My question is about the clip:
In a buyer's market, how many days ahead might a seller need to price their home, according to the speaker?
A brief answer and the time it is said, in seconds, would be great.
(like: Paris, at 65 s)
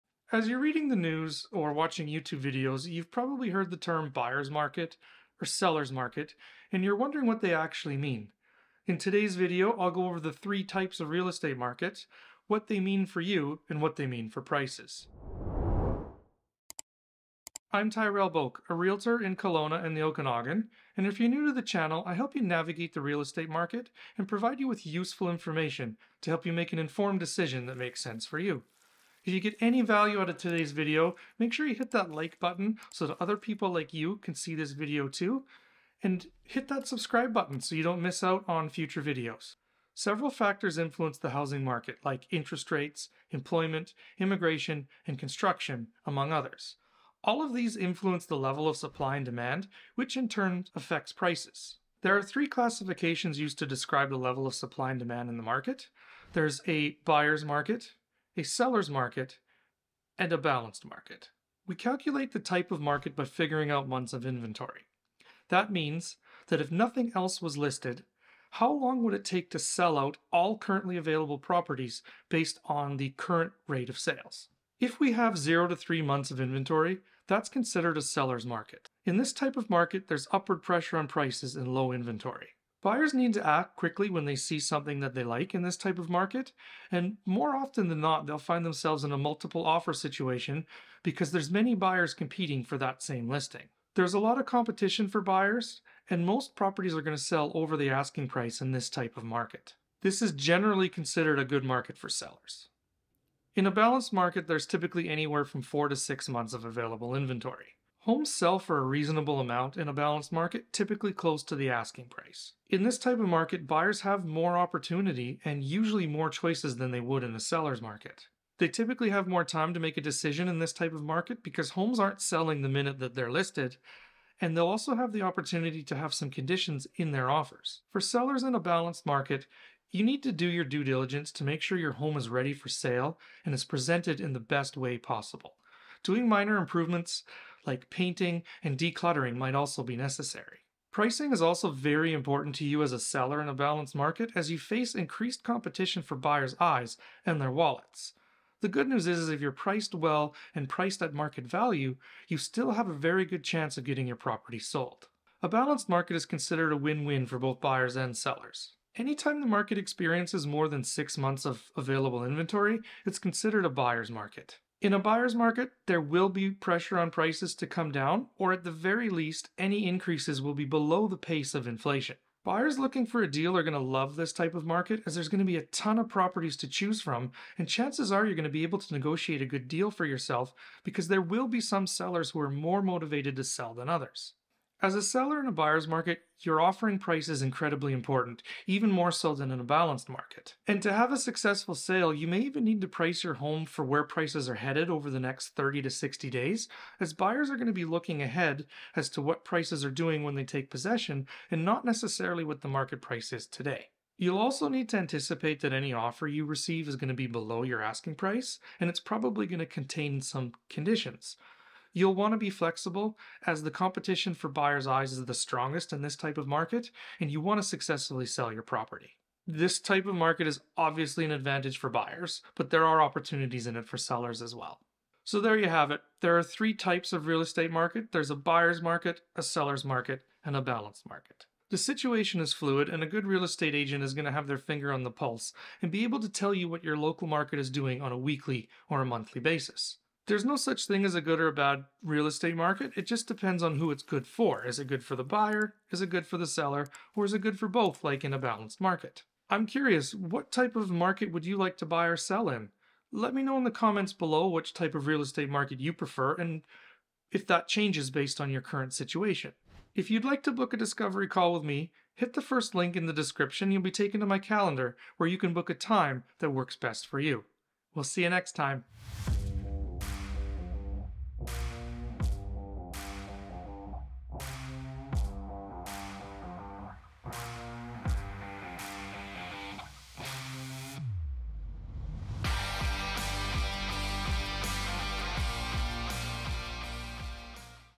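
30 to 60 days, at 195 s.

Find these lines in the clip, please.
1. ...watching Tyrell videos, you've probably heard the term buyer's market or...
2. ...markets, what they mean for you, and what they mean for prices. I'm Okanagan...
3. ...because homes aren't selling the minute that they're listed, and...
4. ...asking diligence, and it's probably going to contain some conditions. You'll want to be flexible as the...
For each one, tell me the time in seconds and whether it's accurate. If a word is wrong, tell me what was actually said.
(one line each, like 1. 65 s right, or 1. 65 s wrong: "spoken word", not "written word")
1. 1 s wrong: "YouTube", not "Tyrell"
2. 11 s wrong: "Tyrell", not "Okanagan"
3. 121 s right
4. 207 s wrong: "price", not "diligence".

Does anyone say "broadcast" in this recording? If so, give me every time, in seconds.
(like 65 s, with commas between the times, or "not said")
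not said.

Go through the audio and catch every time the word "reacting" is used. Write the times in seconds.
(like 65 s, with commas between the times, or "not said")
not said.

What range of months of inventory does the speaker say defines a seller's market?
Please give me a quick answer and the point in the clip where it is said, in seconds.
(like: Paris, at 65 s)
0 to 3 months, at 75 s.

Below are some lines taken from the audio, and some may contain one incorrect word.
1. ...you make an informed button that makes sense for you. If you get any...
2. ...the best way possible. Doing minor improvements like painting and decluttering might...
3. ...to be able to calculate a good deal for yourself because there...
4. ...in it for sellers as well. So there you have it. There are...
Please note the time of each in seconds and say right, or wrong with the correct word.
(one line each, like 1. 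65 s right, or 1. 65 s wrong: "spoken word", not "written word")
1. 26 s wrong: "decision", not "button"
2. 134 s right
3. 178 s wrong: "negotiate", not "calculate"
4. 223 s right.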